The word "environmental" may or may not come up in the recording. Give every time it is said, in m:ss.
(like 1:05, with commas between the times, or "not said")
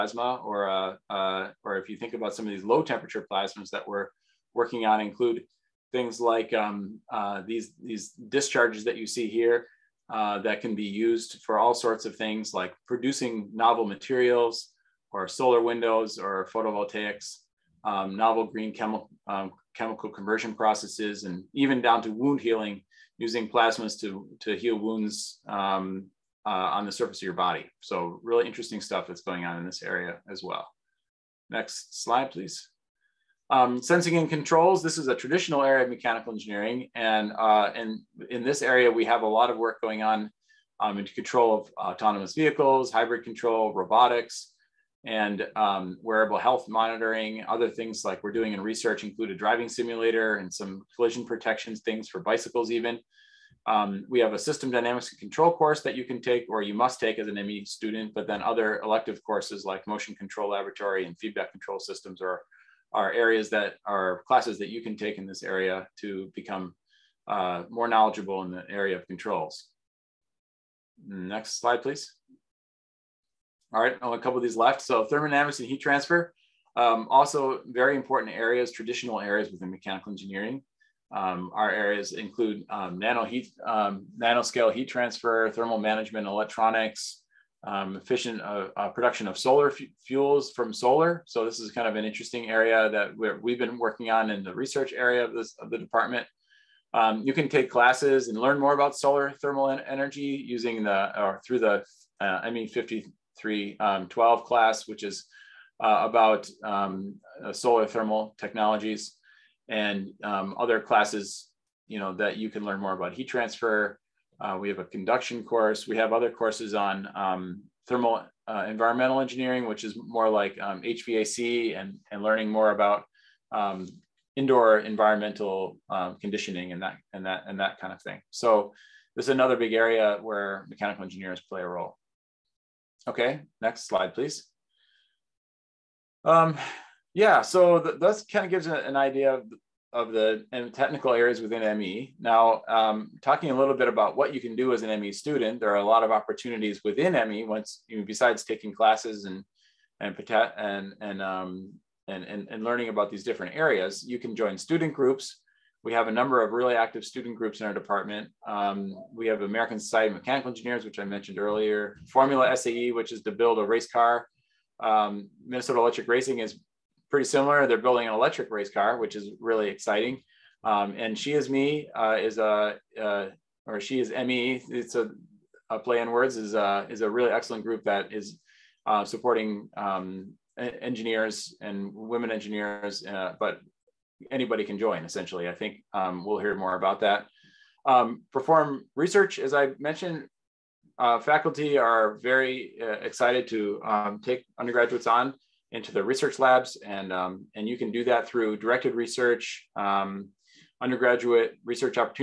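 1:58, 2:04.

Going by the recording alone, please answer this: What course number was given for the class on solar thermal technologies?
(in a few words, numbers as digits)
ME 5312.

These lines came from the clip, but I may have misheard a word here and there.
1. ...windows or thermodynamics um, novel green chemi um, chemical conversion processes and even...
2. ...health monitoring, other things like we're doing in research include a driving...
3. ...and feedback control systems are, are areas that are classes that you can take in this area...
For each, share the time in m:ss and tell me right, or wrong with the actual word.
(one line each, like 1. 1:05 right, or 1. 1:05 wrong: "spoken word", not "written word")
1. 0:15 wrong: "photovoltaics", not "thermodynamics"
2. 0:46 right
3. 1:01 right.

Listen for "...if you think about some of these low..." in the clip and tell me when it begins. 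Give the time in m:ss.
0:01.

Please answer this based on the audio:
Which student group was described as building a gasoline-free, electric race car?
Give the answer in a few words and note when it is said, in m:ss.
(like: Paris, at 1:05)
Minnesota Electric Racing, at 2:45.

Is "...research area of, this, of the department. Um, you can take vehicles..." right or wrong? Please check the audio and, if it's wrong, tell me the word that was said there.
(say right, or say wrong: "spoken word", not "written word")
wrong: "classes", not "vehicles".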